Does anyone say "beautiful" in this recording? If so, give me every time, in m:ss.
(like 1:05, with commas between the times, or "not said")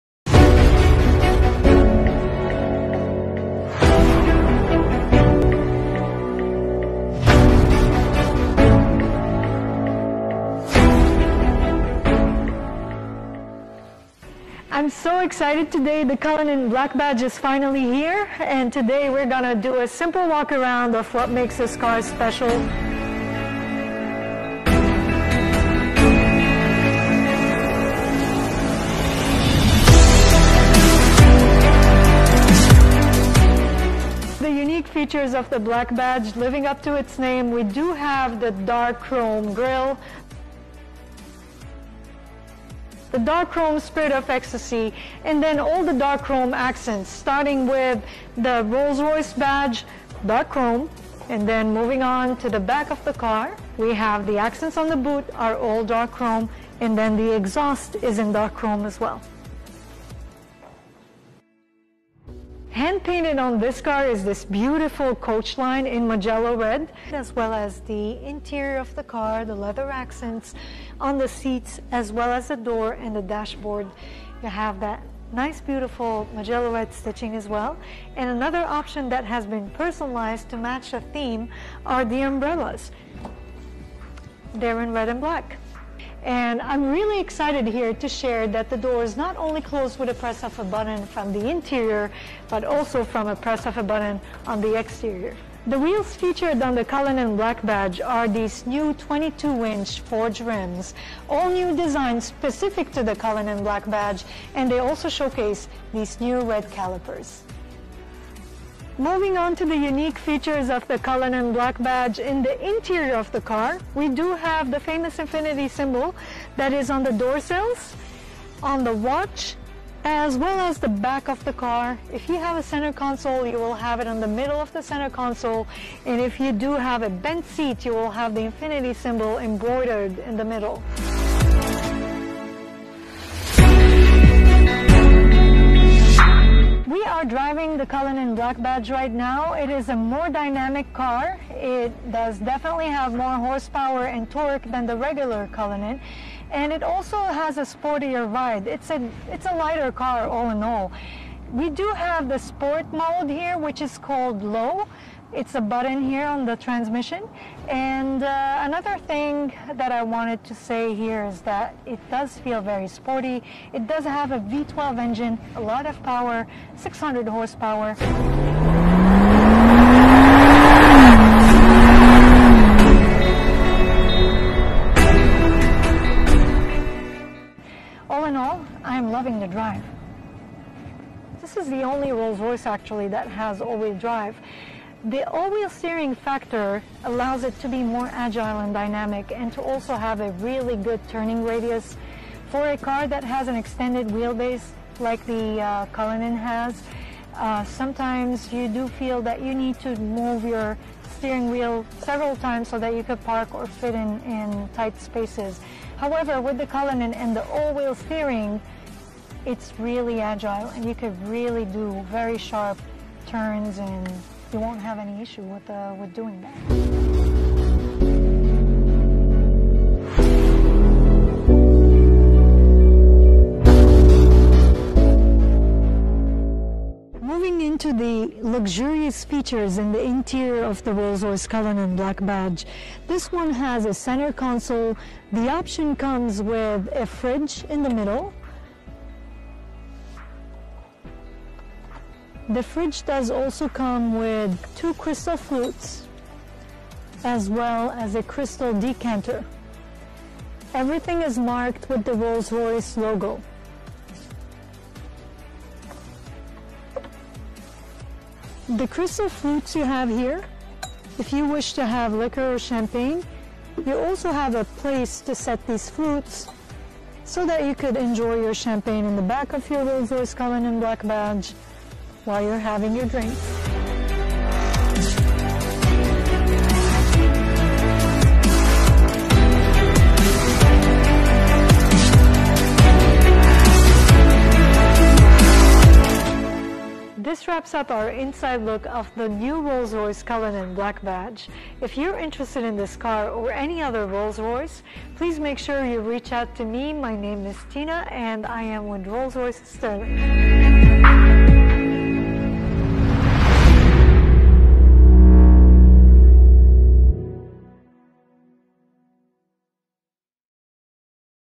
1:04, 1:15.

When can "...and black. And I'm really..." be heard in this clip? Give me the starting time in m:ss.
1:25.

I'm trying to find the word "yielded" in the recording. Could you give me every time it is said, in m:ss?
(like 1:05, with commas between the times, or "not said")
not said.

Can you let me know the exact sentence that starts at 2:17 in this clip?
driving the Cullinan Black Badge right now.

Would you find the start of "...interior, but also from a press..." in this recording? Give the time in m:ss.
1:31.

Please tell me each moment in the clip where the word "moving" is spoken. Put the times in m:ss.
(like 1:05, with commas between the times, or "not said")
0:51, 1:49, 3:47.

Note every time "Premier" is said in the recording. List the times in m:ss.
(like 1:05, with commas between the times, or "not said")
not said.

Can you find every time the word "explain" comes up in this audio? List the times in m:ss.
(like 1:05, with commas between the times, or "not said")
not said.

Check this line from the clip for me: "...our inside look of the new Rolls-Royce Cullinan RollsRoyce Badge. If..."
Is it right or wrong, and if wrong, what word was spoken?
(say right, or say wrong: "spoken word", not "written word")
wrong: "Black", not "RollsRoyce".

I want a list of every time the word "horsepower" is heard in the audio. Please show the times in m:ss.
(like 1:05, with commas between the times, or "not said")
2:23, 2:47.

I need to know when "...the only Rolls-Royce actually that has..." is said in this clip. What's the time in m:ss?
3:01.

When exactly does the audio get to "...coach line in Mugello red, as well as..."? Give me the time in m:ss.
1:05.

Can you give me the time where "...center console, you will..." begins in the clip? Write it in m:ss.
2:02.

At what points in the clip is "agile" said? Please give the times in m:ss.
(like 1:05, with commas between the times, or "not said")
3:08, 3:30.